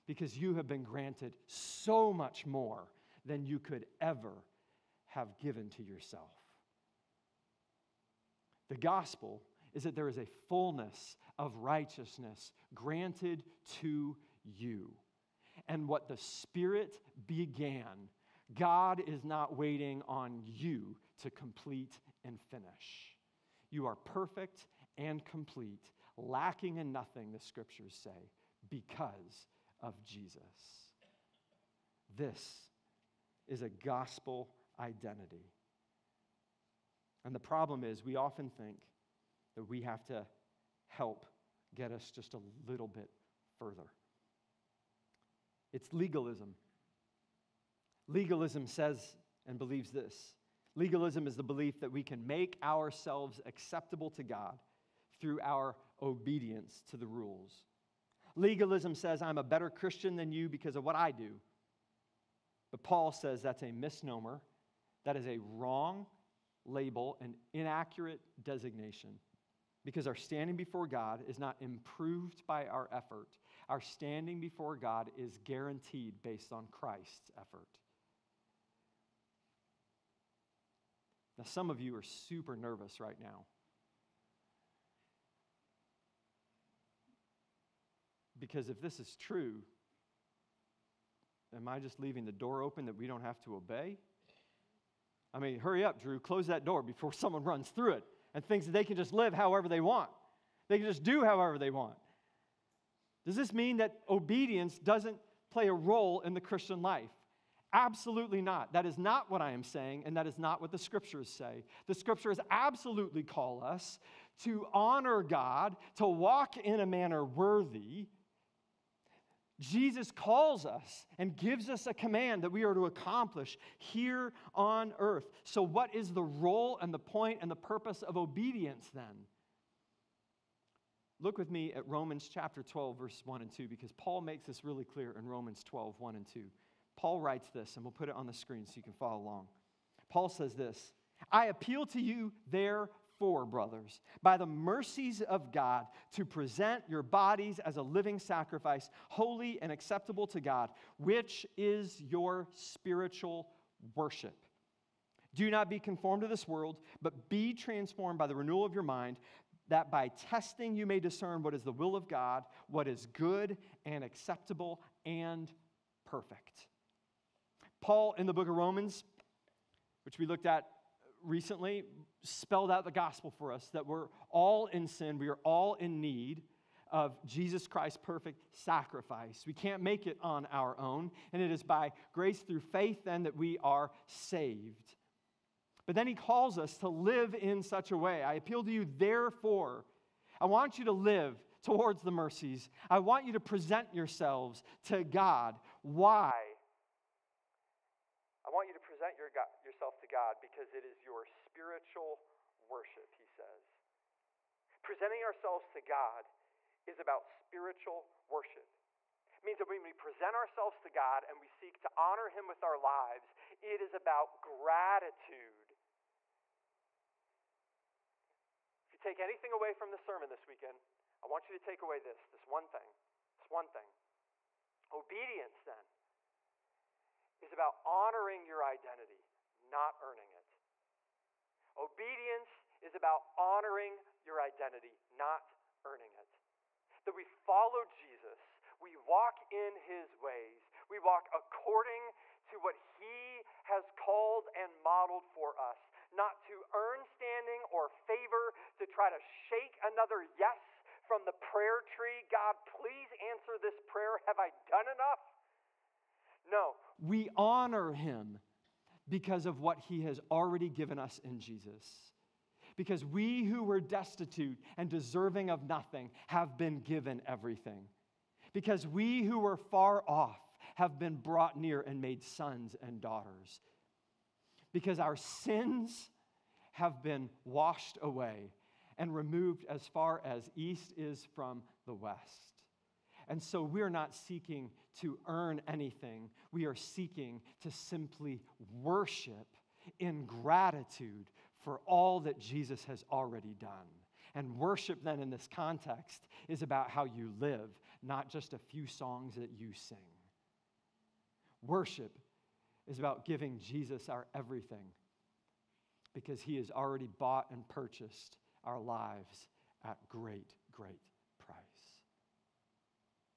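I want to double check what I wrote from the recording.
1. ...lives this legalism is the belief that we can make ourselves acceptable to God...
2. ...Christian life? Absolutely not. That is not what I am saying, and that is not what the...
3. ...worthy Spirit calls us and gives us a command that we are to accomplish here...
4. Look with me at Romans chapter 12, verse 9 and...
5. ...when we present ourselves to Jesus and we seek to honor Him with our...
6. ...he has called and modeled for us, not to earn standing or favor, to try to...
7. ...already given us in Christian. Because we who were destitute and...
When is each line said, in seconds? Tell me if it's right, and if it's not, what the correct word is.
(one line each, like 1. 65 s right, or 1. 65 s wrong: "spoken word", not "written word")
1. 49 s wrong: "believes", not "lives"
2. 106 s right
3. 117 s wrong: "Jesus", not "Spirit"
4. 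131 s wrong: "1", not "9"
5. 209 s wrong: "God", not "Jesus"
6. 242 s right
7. 260 s wrong: "Jesus", not "Christian".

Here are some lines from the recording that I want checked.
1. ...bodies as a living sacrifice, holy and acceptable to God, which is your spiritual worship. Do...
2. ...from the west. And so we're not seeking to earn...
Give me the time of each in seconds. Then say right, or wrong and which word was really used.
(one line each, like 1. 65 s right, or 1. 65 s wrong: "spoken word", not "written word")
1. 147 s right
2. 281 s right.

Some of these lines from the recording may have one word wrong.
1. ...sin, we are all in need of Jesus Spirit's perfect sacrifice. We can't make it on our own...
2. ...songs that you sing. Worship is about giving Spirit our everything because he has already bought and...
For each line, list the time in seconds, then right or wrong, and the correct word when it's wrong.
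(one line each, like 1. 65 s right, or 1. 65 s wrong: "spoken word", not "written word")
1. 174 s wrong: "Christ", not "Spirit"
2. 298 s wrong: "Jesus", not "Spirit".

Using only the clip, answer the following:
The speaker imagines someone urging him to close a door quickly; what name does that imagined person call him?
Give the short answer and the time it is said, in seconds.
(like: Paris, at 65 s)
Drew, at 96 s.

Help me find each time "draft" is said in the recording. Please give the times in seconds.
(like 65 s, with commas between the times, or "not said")
not said.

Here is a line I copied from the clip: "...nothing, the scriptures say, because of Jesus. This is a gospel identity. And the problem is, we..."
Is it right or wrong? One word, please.
right.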